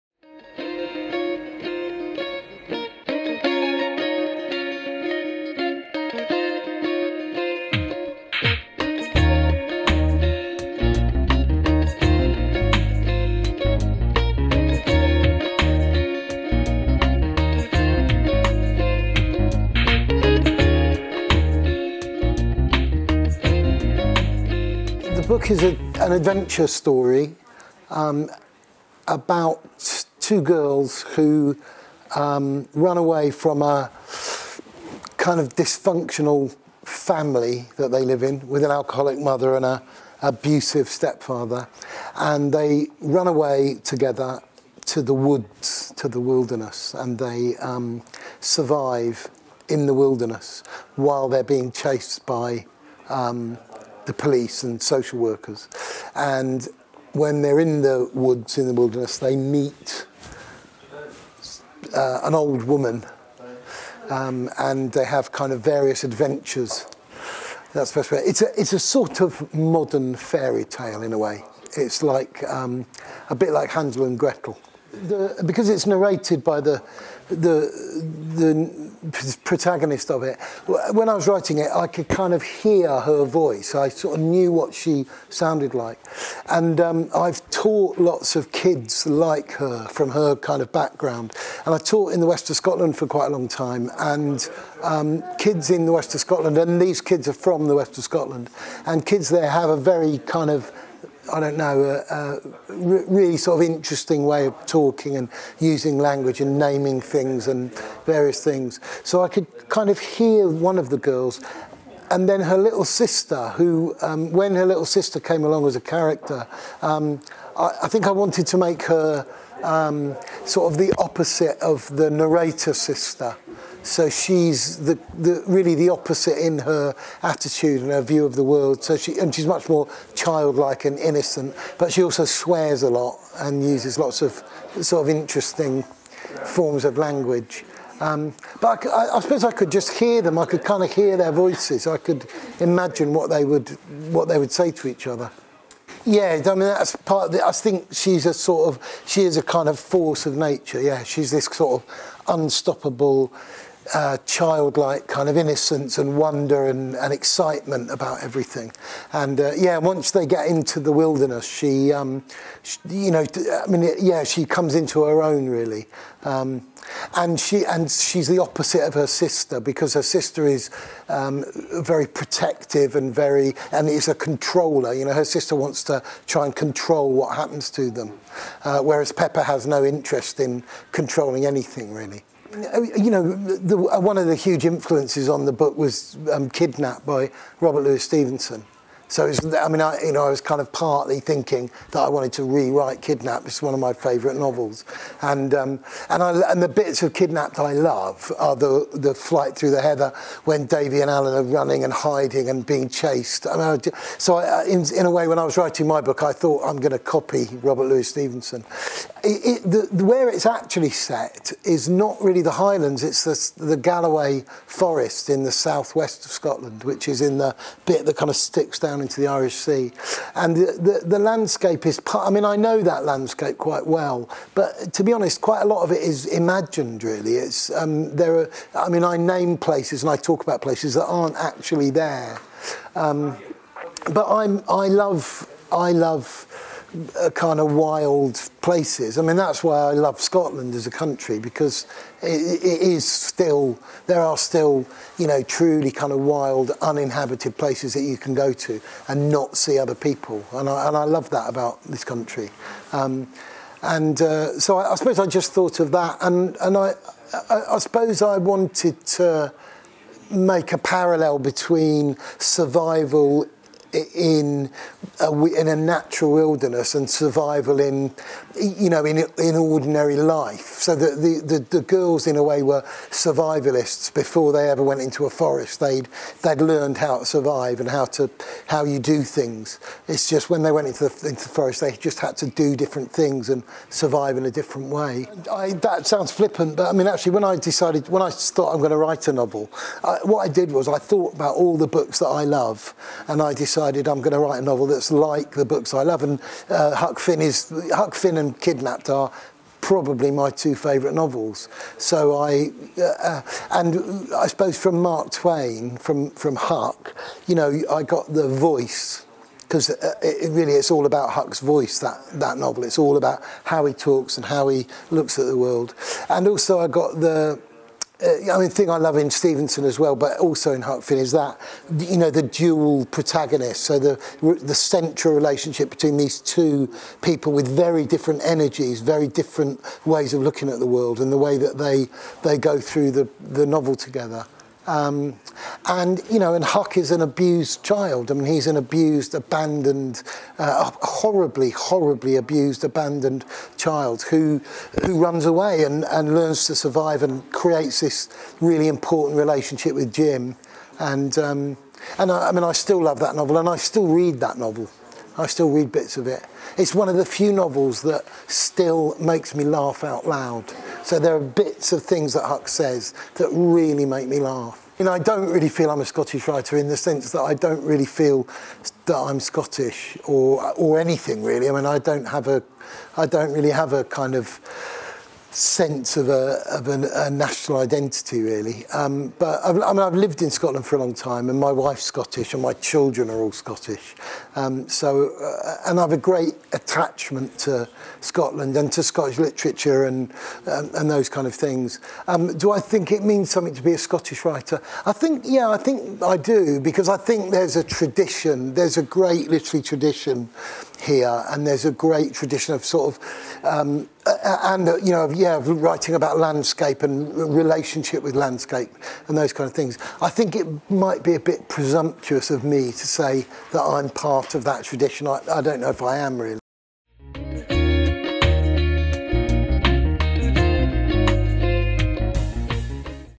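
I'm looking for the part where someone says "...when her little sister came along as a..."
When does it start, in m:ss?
1:54.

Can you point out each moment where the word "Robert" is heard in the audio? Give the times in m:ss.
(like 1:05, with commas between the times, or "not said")
3:07, 3:27.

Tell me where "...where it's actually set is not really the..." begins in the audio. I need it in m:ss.
3:30.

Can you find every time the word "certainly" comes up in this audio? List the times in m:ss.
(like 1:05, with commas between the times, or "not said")
not said.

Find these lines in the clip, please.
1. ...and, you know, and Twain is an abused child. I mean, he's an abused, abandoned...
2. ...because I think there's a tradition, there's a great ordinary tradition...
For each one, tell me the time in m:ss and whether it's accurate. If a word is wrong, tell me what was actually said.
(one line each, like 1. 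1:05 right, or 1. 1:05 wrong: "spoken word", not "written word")
1. 5:35 wrong: "Huck", not "Twain"
2. 6:36 wrong: "literary", not "ordinary".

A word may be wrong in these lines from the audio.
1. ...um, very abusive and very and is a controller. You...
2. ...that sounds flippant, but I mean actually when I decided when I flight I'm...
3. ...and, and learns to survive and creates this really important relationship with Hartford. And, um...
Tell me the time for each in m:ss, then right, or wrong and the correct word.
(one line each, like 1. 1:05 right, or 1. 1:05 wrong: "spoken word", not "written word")
1. 2:51 wrong: "protective", not "abusive"
2. 4:45 wrong: "thought", not "flight"
3. 5:45 wrong: "Jim", not "Hartford".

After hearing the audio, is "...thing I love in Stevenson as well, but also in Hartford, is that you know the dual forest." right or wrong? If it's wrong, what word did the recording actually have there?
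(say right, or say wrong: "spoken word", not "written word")
wrong: "protagonist", not "forest".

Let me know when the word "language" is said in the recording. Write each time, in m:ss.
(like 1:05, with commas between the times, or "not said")
1:45, 2:16.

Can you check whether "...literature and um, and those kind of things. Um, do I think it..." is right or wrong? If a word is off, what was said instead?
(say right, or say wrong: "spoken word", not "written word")
right.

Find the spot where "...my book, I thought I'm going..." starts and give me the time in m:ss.
3:25.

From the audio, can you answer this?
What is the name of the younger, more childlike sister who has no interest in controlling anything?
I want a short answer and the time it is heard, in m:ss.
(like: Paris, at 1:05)
Pepper, at 2:59.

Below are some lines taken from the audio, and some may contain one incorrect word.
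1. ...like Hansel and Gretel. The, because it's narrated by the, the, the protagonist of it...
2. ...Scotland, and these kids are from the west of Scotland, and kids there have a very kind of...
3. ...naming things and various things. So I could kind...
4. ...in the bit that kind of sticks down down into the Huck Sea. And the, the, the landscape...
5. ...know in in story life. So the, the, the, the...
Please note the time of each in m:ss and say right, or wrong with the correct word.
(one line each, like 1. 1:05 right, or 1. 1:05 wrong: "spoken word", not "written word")
1. 1:13 right
2. 1:36 right
3. 1:46 right
4. 3:37 wrong: "Irish", not "Huck"
5. 4:28 wrong: "ordinary", not "story".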